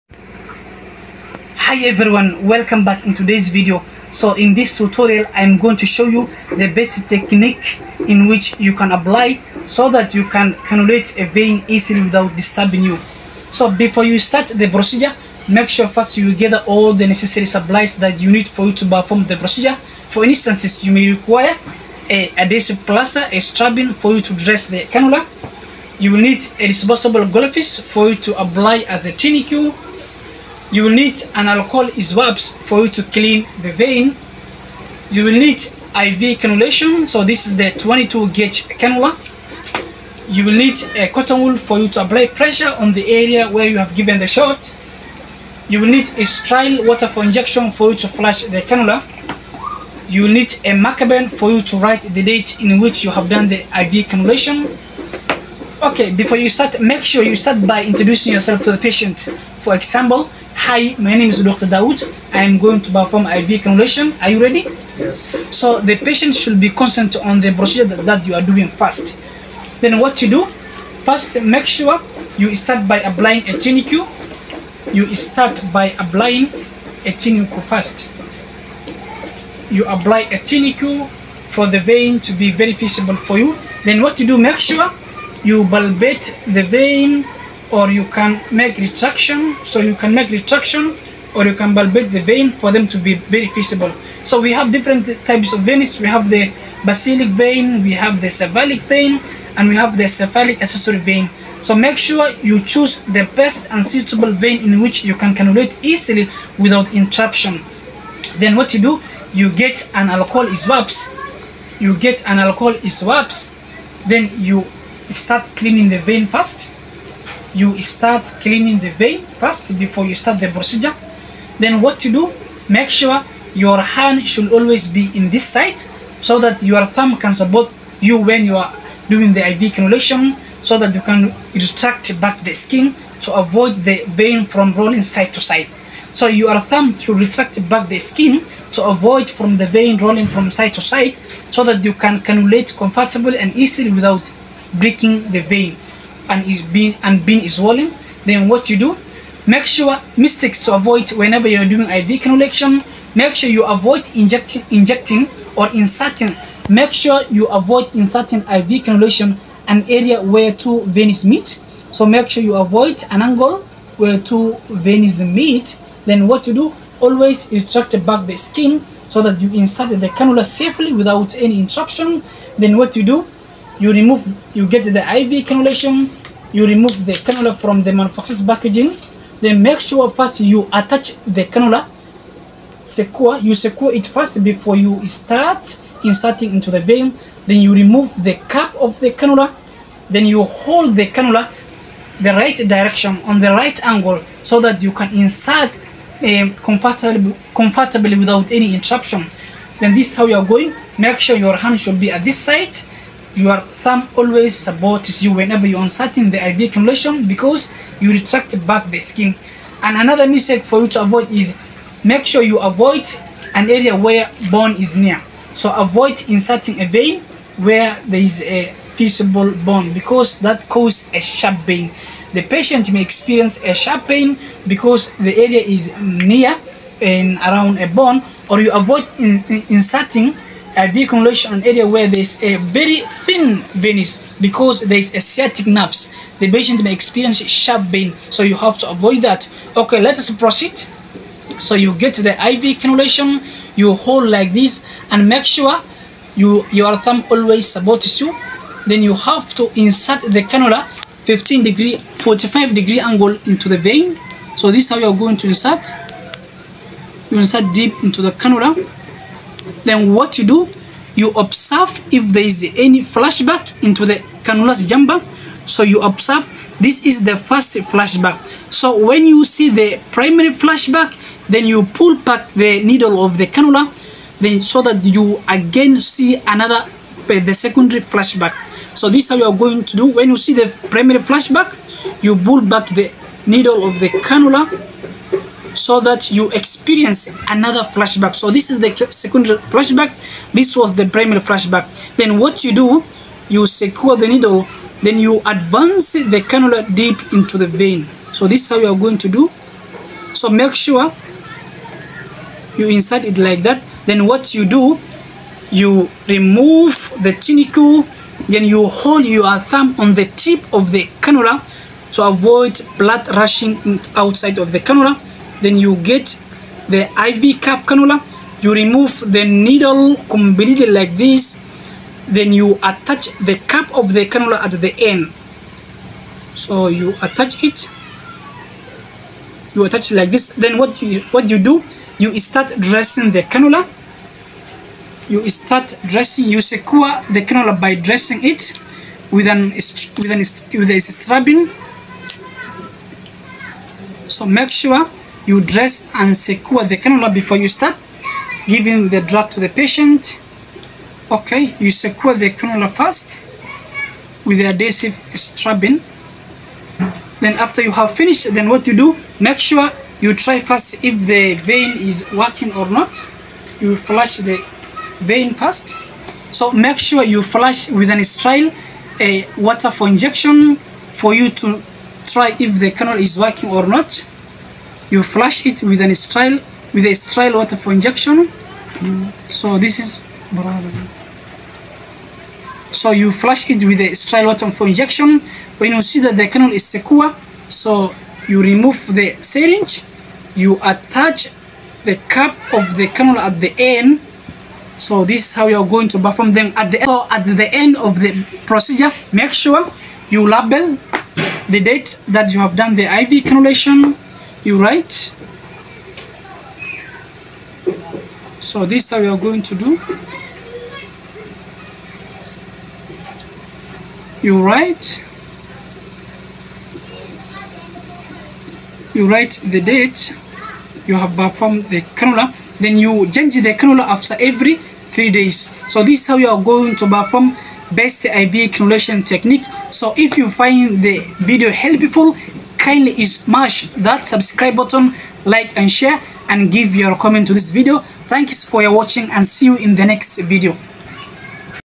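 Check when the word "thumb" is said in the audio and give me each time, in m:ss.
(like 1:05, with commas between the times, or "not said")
2:06, 2:16, 3:23, 4:06, 5:09.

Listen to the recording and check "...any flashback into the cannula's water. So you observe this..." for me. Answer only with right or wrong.
wrong.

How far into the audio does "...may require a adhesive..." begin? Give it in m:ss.
0:20.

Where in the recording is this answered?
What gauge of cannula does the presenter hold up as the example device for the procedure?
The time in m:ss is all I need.
0:37.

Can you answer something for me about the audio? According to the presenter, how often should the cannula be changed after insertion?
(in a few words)
every 3 days.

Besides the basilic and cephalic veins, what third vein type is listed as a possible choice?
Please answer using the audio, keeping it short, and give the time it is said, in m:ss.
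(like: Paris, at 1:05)
cephalic accessory vein, at 1:40.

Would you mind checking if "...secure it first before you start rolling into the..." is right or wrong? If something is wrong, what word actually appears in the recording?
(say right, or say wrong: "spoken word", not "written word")
wrong: "inserting", not "rolling".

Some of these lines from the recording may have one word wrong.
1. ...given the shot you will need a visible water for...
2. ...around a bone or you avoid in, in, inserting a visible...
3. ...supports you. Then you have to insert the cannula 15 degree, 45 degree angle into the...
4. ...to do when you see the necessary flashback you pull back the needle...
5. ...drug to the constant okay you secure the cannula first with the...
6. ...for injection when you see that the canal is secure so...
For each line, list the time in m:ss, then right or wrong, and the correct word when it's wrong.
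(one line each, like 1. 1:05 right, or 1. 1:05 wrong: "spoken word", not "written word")
1. 0:43 wrong: "sterile", not "visible"
2. 3:47 wrong: "vehicle", not "visible"
3. 4:07 right
4. 4:39 wrong: "primary", not "necessary"
5. 5:49 wrong: "patient", not "constant"
6. 6:24 right.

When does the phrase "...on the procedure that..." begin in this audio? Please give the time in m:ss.
1:07.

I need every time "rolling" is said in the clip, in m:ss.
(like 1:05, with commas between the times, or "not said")
2:14, 2:19.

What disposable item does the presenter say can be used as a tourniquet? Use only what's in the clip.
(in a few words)
goldfish.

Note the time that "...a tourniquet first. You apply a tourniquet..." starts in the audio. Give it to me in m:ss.
1:17.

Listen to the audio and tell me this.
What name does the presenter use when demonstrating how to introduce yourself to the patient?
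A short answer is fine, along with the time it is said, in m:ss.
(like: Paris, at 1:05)
Dr. Daoud, at 1:01.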